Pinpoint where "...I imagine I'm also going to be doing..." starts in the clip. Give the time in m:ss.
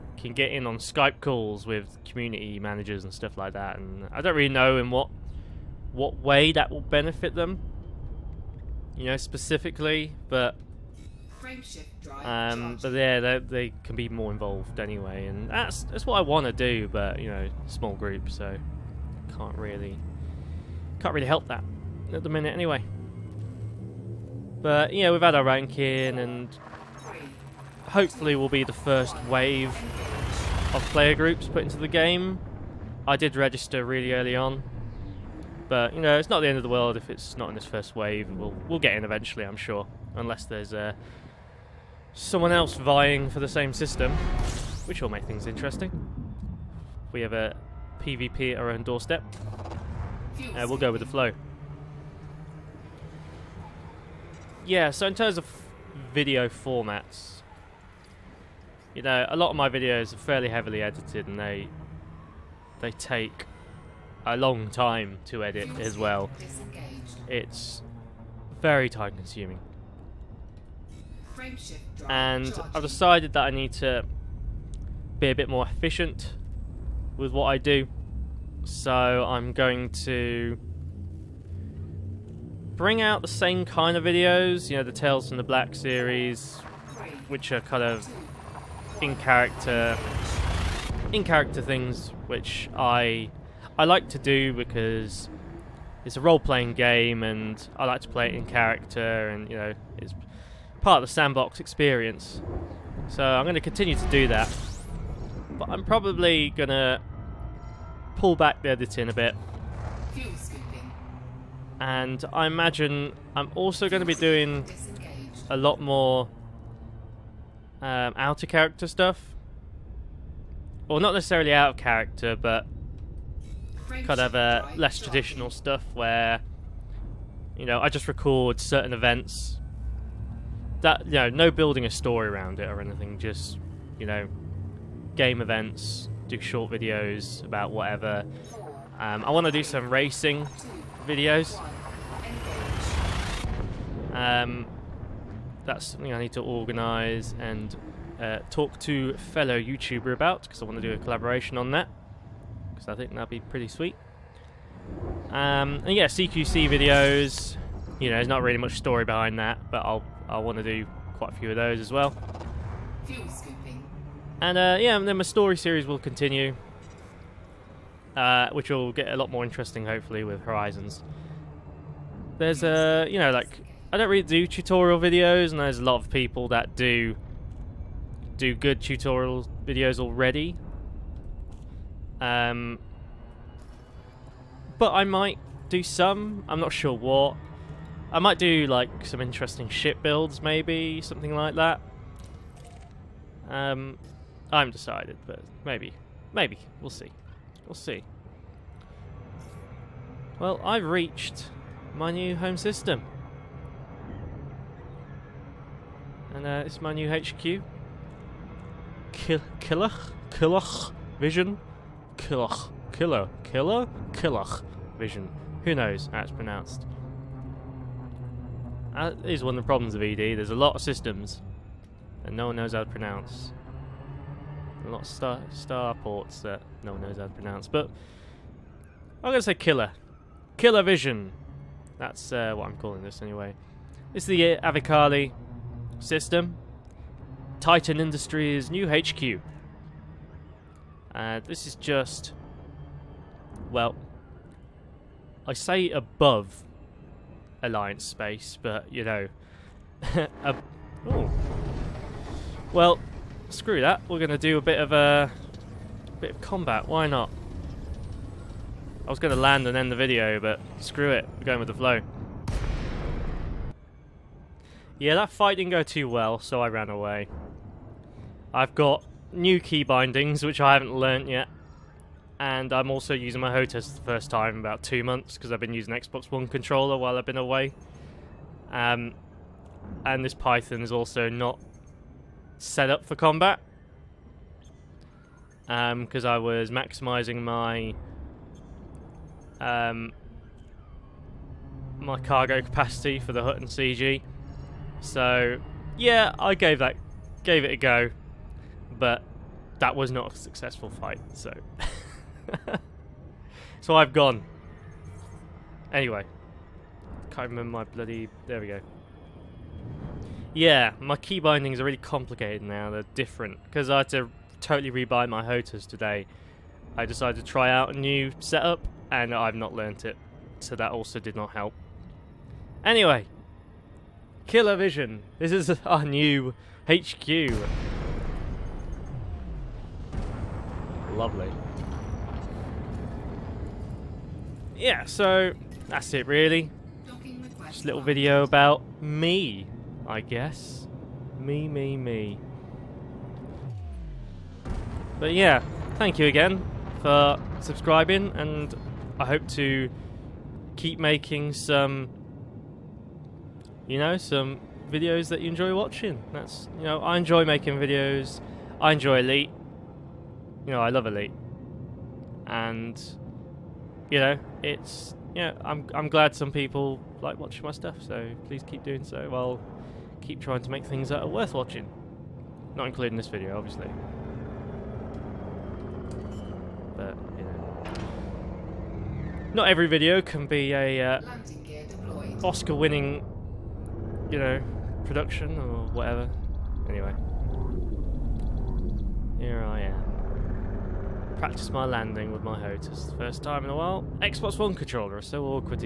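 1:52.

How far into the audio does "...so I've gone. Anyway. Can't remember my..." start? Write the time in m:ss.
5:03.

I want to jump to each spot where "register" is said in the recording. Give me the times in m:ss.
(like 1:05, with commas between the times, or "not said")
0:33.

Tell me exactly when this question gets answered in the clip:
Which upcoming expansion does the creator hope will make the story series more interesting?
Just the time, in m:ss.
2:50.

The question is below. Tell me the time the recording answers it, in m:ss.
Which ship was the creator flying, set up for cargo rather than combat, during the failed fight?
4:40.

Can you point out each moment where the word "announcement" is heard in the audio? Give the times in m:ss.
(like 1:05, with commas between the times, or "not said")
not said.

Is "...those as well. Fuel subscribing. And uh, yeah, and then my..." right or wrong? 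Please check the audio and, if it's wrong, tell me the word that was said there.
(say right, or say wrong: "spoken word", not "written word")
wrong: "scooping", not "subscribing".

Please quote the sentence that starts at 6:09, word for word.
I'll keep trying to make things that are worth watching.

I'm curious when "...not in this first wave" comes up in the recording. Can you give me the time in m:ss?
0:37.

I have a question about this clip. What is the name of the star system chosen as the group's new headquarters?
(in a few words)
Avicali.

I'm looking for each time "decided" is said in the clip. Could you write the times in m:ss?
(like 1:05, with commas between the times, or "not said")
1:12, 3:14, 5:17.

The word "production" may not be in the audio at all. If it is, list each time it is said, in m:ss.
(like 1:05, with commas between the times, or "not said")
6:25.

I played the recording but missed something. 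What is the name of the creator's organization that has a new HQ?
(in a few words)
Titan Industries.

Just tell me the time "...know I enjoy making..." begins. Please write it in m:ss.
5:56.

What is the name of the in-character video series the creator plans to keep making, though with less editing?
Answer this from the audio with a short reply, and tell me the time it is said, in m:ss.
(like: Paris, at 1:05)
Tales from the Black, at 1:24.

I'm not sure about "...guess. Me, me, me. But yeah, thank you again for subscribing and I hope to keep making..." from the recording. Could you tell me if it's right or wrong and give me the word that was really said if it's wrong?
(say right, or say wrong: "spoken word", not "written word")
right.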